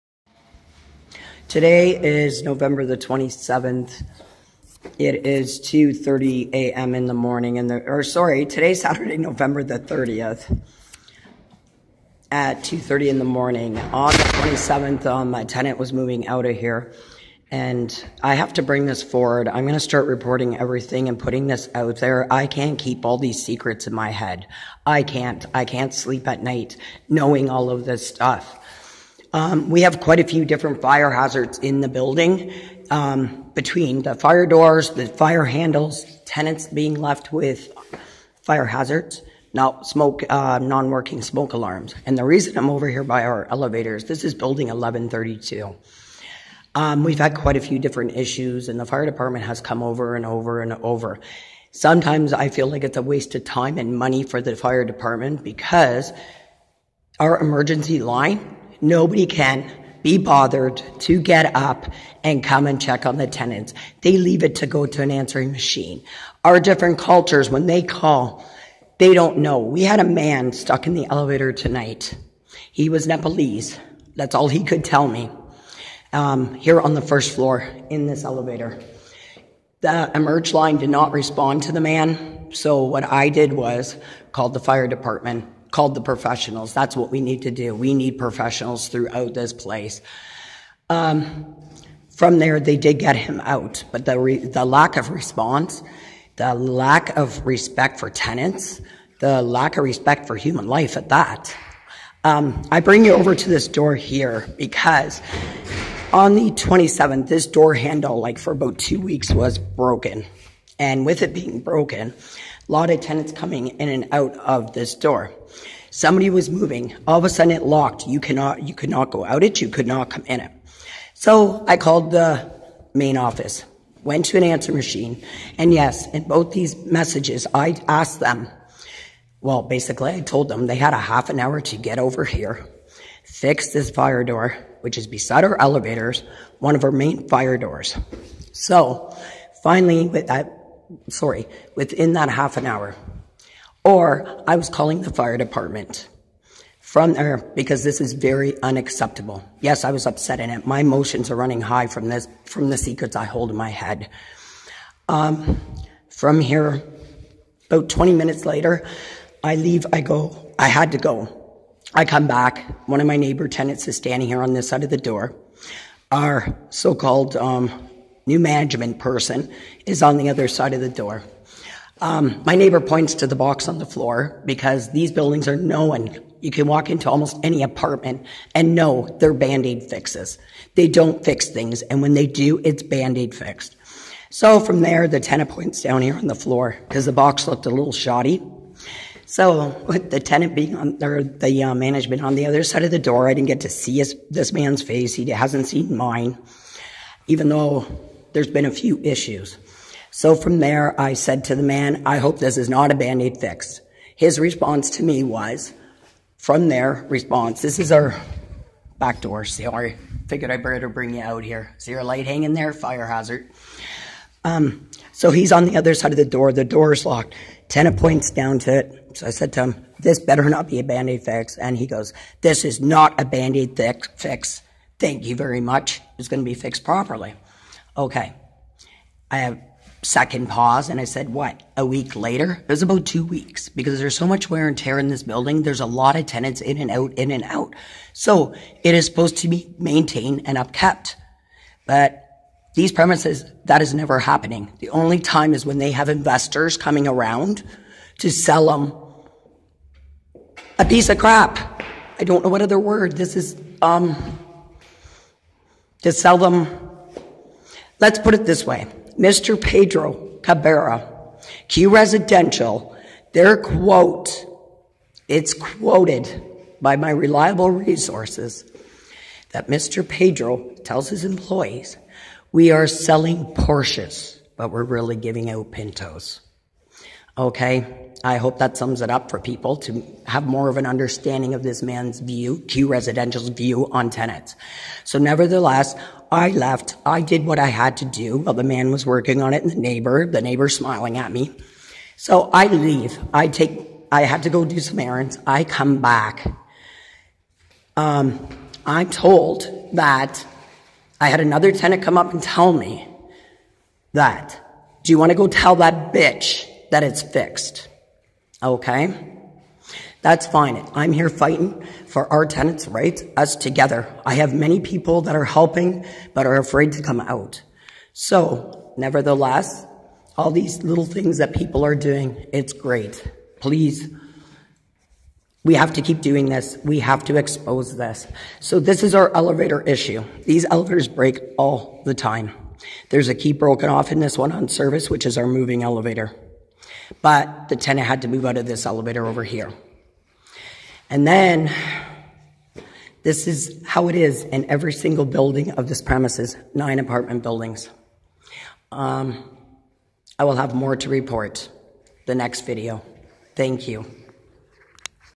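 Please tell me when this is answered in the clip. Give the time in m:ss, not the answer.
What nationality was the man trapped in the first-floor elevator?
1:13.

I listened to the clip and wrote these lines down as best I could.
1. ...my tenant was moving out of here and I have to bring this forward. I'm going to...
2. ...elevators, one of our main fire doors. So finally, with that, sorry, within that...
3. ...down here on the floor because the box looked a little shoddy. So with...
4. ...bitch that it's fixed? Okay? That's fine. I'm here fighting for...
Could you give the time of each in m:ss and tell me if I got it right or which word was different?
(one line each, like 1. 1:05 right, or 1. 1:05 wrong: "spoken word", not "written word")
1. 0:15 right
2. 2:15 right
3. 3:05 right
4. 5:06 right.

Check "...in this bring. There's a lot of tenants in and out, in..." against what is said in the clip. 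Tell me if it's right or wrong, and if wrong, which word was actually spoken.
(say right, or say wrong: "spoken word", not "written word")
wrong: "building", not "bring".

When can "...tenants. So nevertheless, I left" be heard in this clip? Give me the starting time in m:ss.
4:44.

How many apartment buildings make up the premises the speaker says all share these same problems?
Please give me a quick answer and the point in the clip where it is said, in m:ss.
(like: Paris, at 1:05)
9, at 5:46.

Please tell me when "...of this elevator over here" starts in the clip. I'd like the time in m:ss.
5:38.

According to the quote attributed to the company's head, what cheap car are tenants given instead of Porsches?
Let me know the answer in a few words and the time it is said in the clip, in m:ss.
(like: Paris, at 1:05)
Pintos, at 4:35.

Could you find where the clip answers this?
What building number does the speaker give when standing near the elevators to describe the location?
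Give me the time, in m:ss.
0:44.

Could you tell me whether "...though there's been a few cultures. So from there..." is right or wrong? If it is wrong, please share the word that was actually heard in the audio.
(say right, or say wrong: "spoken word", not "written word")
wrong: "issues", not "cultures".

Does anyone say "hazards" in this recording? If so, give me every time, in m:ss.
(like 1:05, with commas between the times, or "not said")
0:31, 0:38, 3:33.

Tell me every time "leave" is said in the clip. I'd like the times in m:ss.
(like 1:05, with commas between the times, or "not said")
1:04, 2:39, 4:52.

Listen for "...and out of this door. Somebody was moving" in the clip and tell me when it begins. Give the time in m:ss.
1:53.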